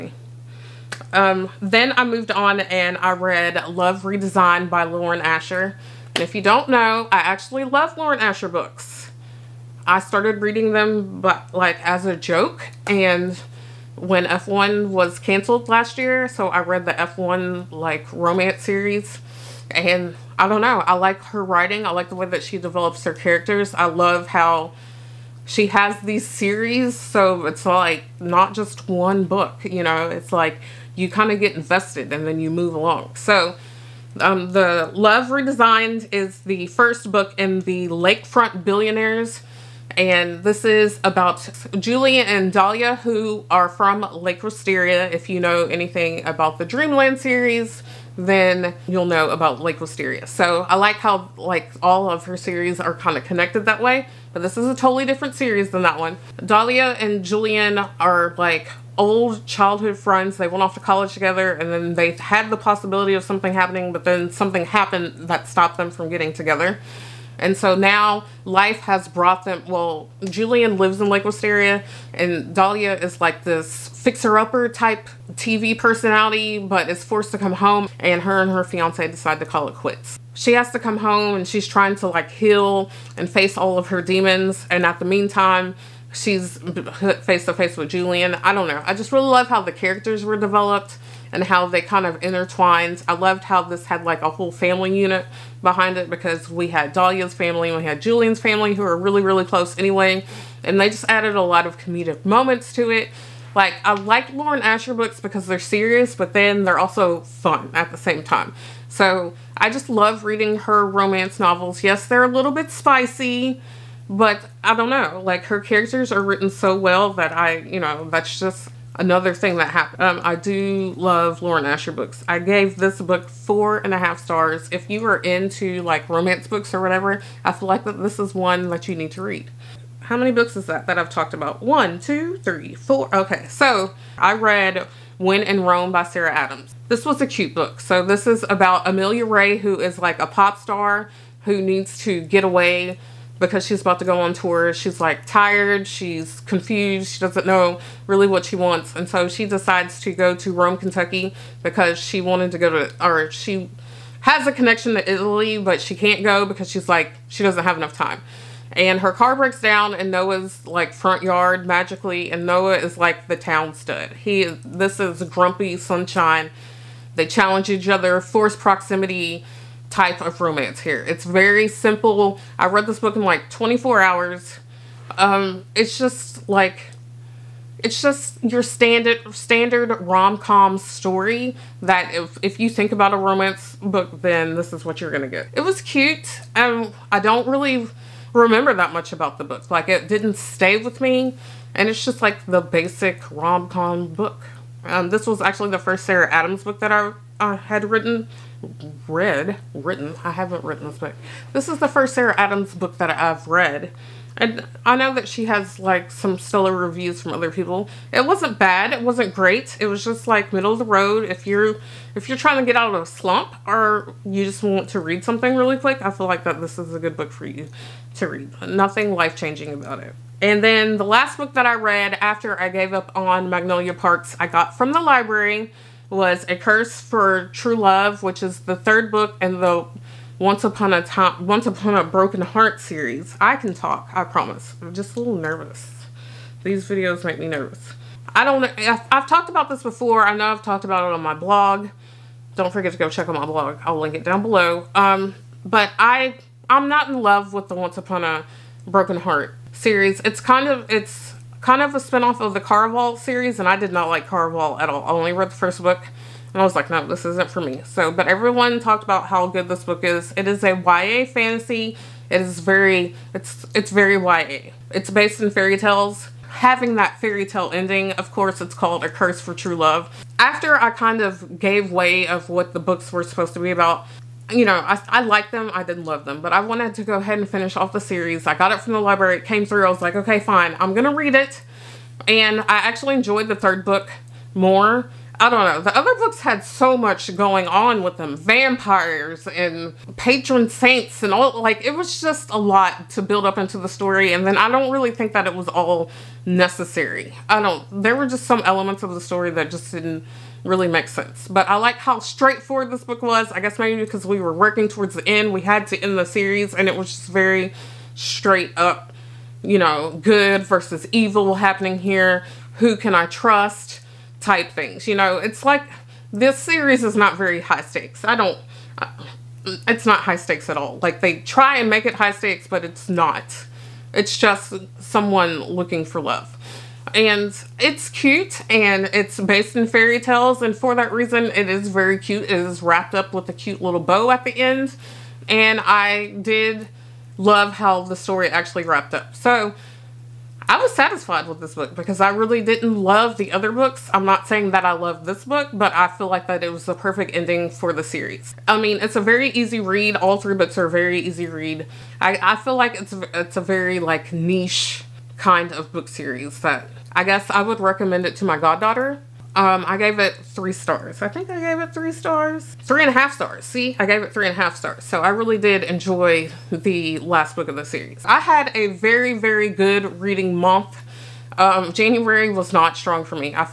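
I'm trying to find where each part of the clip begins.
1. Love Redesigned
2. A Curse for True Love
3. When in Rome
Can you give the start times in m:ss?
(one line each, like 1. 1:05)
1. 0:09
2. 4:02
3. 2:11.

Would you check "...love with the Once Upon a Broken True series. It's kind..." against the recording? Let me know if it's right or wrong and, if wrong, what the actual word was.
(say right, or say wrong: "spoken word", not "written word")
wrong: "Heart", not "True".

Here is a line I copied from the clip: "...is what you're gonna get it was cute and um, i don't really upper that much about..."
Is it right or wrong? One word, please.
wrong.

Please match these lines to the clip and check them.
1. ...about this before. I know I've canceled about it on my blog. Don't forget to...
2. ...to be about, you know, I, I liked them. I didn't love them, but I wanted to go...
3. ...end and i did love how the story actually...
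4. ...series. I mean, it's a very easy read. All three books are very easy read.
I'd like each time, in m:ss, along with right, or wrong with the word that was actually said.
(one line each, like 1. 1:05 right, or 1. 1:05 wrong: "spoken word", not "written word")
1. 3:59 wrong: "talked", not "canceled"
2. 4:33 right
3. 5:34 right
4. 5:48 right.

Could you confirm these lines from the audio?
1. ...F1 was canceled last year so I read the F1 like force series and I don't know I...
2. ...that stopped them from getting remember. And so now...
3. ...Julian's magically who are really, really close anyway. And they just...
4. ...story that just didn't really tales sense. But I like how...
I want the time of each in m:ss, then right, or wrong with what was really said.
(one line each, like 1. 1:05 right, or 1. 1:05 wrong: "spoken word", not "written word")
1. 0:14 wrong: "romance", not "force"
2. 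1:05 wrong: "together", not "remember"
3. 1:38 wrong: "family", not "magically"
4. 4:59 wrong: "makes", not "tales".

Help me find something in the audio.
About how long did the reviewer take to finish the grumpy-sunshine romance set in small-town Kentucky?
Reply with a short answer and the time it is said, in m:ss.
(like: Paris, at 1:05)
24 hours, at 2:53.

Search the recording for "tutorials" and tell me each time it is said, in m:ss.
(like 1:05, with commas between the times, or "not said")
not said.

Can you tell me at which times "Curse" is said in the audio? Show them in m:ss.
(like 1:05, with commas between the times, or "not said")
3:46, 4:29.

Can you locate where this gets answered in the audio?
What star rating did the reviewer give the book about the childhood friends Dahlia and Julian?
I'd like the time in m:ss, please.
2:03.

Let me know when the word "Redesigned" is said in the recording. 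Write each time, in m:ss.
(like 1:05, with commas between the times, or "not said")
0:04, 0:35.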